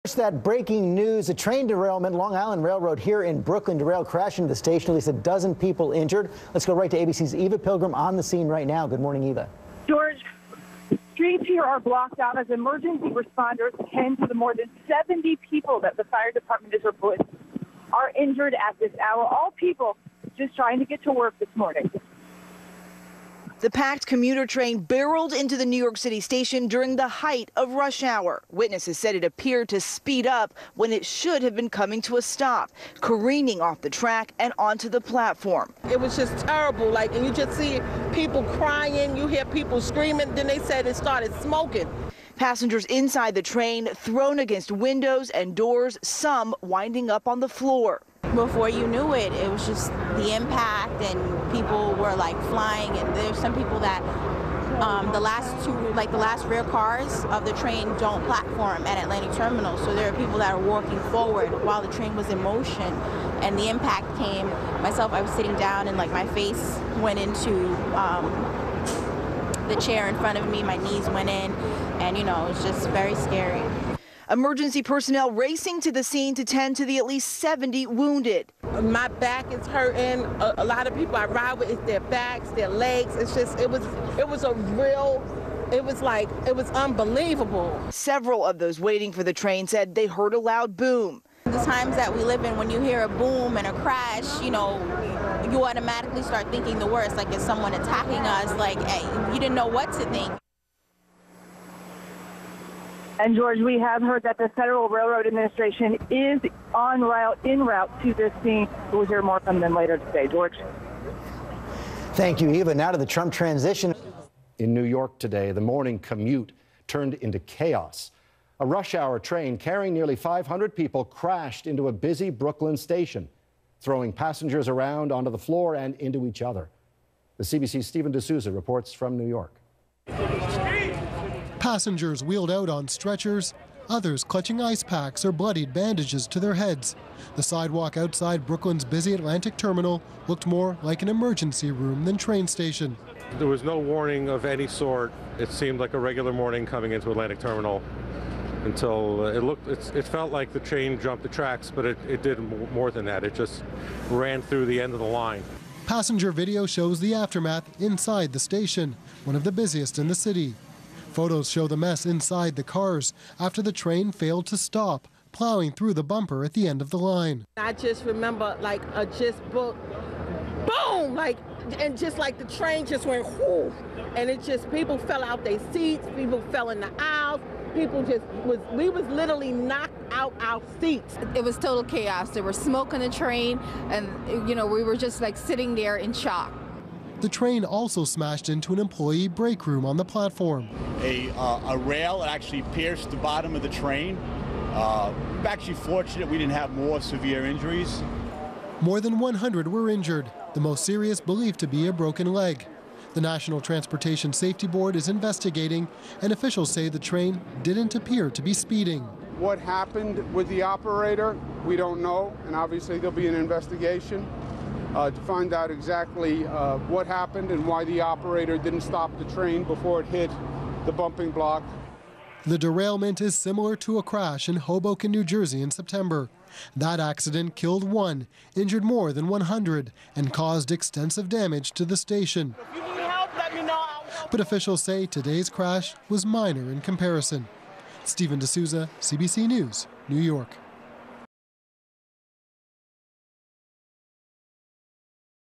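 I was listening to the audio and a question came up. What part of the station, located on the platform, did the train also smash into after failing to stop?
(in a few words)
employee break room.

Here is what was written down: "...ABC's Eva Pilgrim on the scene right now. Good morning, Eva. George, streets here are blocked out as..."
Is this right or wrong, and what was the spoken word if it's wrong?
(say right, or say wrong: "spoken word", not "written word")
right.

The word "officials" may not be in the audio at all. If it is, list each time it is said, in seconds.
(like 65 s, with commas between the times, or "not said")
206 s, 234 s.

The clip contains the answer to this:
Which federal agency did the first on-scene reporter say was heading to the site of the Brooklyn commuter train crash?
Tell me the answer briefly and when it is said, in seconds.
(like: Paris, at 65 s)
Federal Railroad Administration, at 104 s.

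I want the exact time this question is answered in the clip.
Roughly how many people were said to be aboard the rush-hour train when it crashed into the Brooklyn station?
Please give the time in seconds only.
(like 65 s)
119 s.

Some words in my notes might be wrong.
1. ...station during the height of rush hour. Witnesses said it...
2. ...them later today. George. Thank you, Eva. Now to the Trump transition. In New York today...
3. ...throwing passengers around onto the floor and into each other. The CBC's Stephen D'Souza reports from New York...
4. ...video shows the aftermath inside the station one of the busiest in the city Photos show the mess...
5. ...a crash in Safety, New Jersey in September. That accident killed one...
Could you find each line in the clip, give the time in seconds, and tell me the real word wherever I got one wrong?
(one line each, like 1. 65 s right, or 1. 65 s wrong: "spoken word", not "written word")
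1. 26 s right
2. 109 s right
3. 123 s right
4. 156 s right
5. 223 s wrong: "Hoboken", not "Safety".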